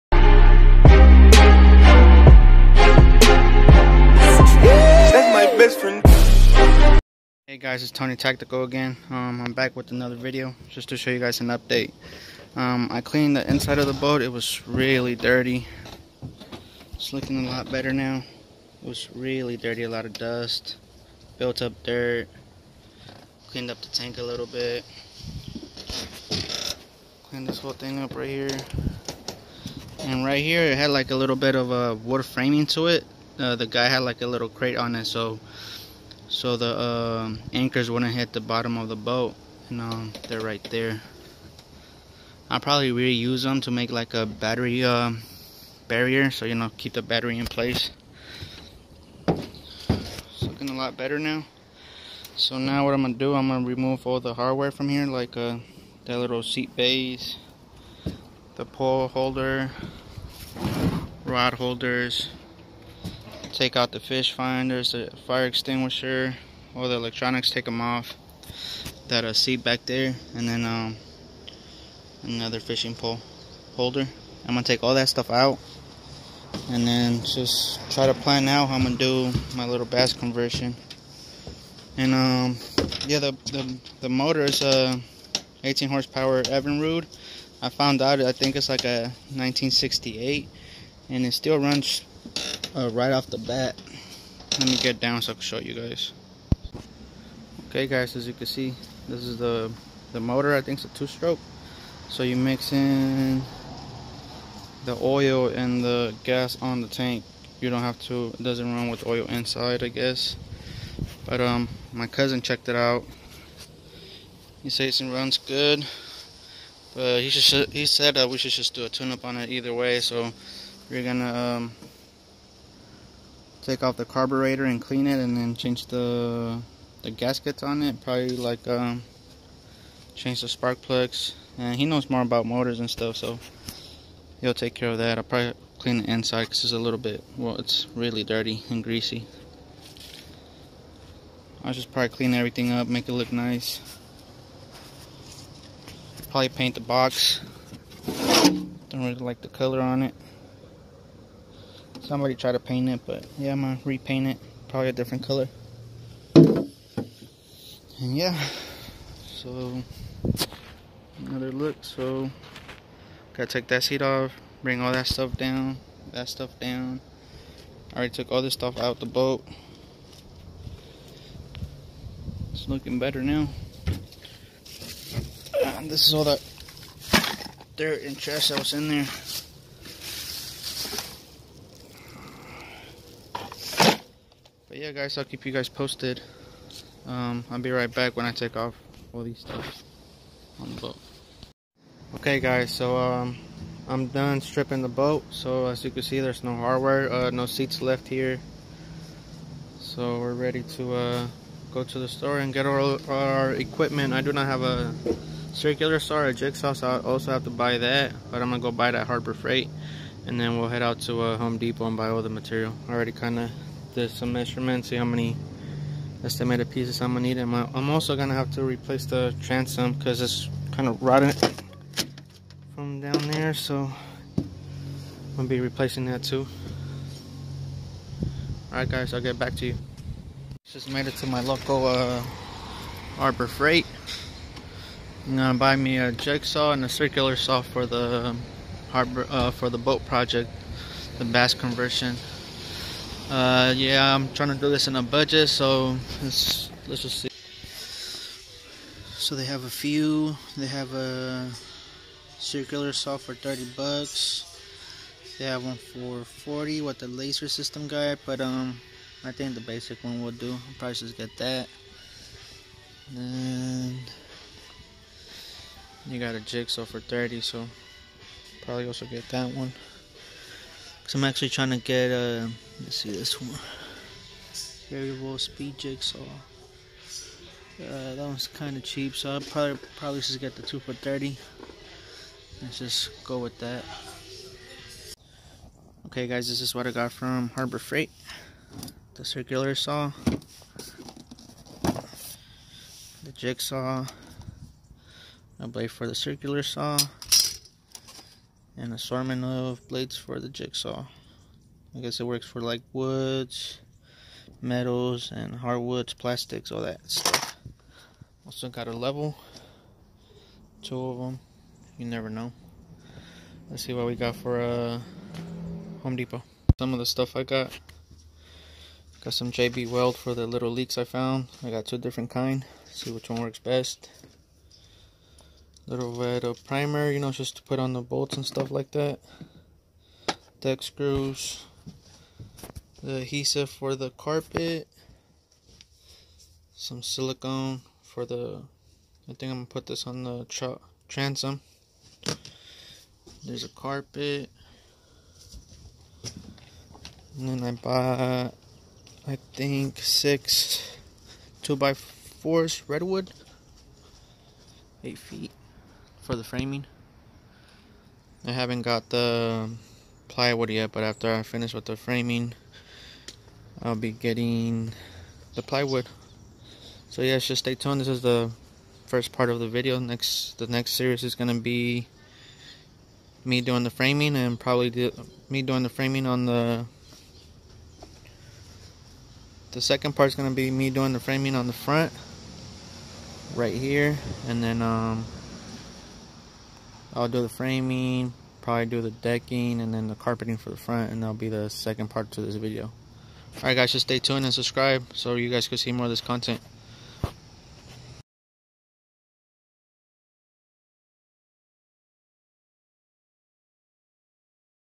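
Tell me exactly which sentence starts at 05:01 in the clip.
I guess it works for like woods, metals, and hardwoods, plastics, all that stuff.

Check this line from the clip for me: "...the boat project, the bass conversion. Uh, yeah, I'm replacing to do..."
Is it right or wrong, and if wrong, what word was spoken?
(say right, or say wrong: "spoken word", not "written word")
wrong: "trying", not "replacing".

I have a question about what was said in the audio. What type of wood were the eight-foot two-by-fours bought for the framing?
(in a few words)
redwood.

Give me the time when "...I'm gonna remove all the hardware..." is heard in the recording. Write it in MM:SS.
00:53.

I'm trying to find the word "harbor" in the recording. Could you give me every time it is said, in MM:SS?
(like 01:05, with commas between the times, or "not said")
03:29, 03:53, 03:58, 04:47.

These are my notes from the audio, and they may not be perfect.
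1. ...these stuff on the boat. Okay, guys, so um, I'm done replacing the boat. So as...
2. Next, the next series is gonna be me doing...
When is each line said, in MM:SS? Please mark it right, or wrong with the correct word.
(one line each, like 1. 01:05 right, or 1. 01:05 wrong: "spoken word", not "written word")
1. 03:09 wrong: "stripping", not "replacing"
2. 06:09 right.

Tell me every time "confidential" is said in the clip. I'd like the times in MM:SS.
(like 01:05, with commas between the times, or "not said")
not said.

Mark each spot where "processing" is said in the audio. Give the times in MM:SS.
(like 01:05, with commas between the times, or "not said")
not said.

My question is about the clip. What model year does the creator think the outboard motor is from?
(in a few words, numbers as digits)
1968.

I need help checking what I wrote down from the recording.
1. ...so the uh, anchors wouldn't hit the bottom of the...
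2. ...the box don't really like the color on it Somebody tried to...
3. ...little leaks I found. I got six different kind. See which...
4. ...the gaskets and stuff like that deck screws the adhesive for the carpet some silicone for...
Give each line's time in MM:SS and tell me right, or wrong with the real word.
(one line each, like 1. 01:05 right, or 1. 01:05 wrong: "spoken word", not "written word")
1. 00:36 right
2. 02:26 right
3. 05:20 wrong: "two", not "six"
4. 05:27 wrong: "bolts", not "gaskets".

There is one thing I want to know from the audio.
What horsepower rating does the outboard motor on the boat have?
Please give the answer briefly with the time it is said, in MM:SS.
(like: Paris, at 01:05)
18, at 01:25.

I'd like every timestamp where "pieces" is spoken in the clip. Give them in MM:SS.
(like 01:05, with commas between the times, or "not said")
03:36.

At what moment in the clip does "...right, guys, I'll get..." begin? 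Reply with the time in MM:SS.
03:48.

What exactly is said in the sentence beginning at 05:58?
I haven't got the plywood yet, but after I finish with the framing, I'll be getting the plywood.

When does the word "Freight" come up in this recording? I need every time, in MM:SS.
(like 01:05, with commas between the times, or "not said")
03:29, 03:53, 04:47.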